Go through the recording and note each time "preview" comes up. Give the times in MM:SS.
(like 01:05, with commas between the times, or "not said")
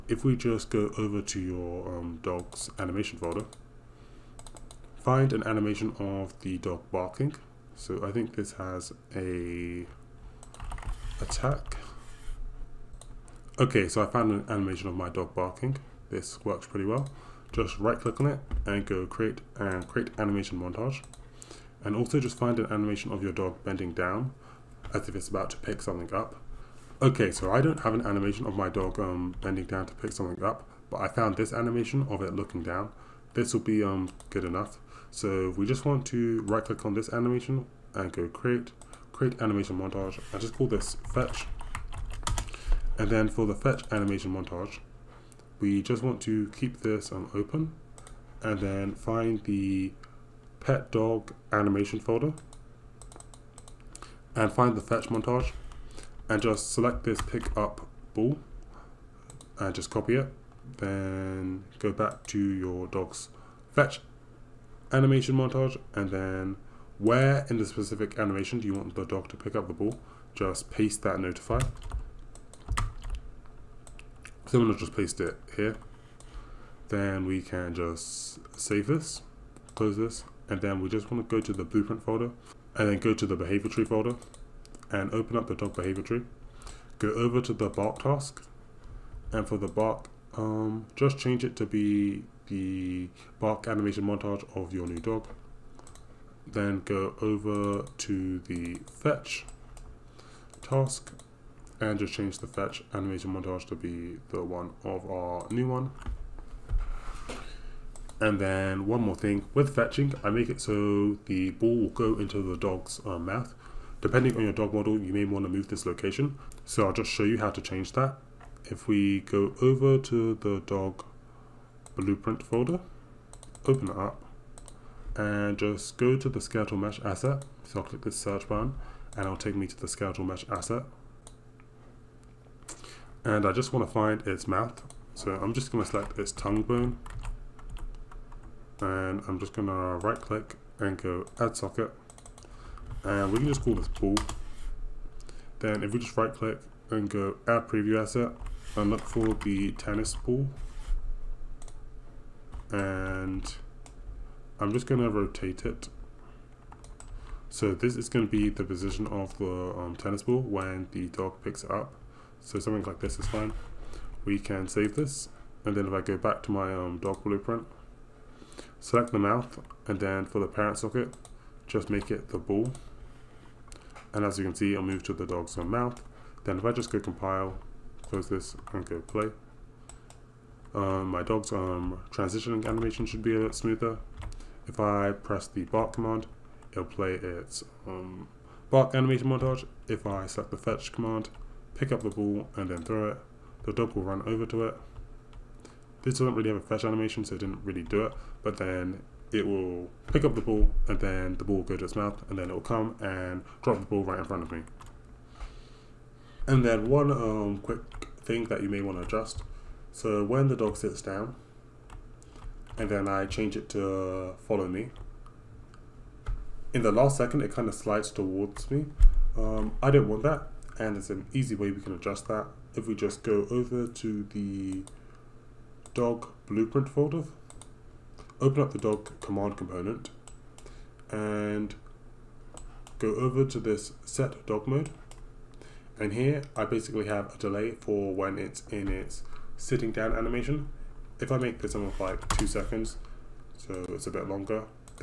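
02:27.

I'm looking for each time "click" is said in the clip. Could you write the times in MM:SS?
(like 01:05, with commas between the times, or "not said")
00:17, 00:36, 02:07, 02:20, 02:26.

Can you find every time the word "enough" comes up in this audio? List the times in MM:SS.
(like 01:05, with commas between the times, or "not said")
00:34.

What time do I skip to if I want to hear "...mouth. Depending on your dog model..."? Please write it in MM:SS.
01:53.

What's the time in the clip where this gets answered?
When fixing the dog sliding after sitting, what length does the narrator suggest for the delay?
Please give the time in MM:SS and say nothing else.
04:02.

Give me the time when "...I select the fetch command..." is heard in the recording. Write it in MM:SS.
03:10.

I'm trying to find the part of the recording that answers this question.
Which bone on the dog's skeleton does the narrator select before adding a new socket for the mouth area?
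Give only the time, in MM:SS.
02:16.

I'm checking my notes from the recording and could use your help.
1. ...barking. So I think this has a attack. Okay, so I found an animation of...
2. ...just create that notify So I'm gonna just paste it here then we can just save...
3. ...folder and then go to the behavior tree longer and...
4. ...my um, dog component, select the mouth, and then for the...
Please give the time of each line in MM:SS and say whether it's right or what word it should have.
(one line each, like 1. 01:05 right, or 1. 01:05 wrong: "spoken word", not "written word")
1. 00:06 right
2. 01:10 wrong: "paste", not "create"
3. 01:22 wrong: "folder", not "longer"
4. 02:46 wrong: "blueprint", not "component".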